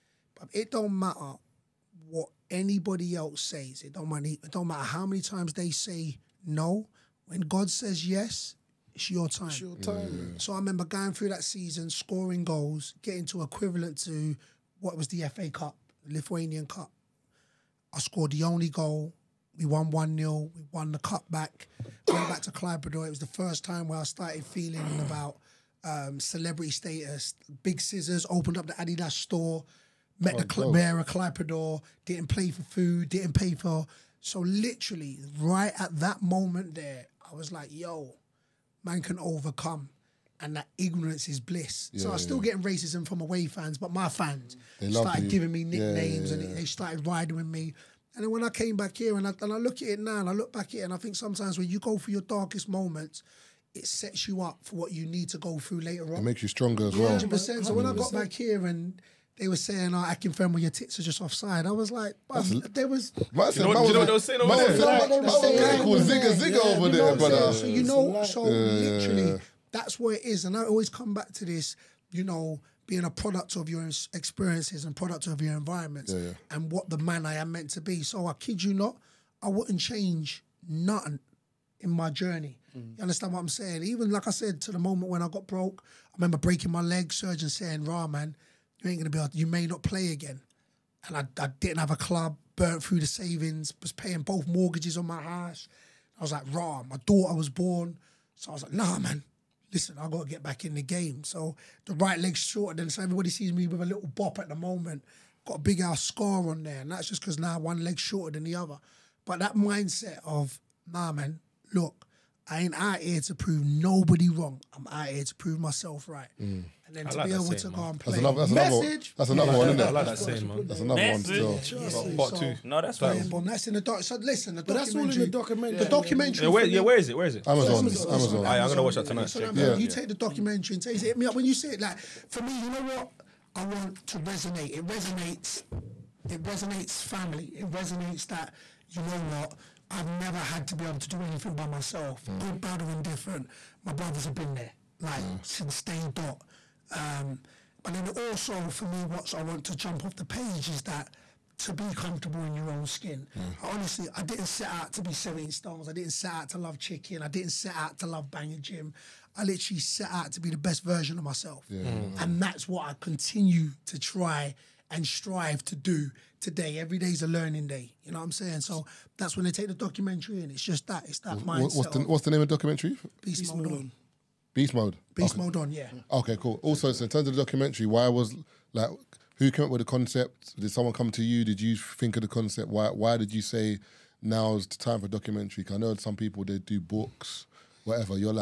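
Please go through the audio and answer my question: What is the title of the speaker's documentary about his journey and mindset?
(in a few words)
Beast Mode On.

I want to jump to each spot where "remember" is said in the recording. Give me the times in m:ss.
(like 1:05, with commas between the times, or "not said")
0:10, 1:26.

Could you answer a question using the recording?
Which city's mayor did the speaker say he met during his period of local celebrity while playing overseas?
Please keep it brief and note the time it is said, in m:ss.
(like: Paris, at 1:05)
Klaipeda, at 0:31.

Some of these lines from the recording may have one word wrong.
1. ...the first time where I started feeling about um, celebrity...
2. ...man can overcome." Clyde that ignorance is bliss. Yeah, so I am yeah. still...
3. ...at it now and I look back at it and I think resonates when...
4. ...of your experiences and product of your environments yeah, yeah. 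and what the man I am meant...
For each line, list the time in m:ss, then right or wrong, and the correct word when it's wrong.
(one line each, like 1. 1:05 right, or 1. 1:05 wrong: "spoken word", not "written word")
1. 0:23 right
2. 0:38 wrong: "And", not "Clyde"
3. 0:49 wrong: "sometimes", not "resonates"
4. 1:13 right.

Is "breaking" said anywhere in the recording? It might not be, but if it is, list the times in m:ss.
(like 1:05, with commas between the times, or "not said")
1:26.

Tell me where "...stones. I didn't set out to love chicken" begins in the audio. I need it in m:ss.
2:35.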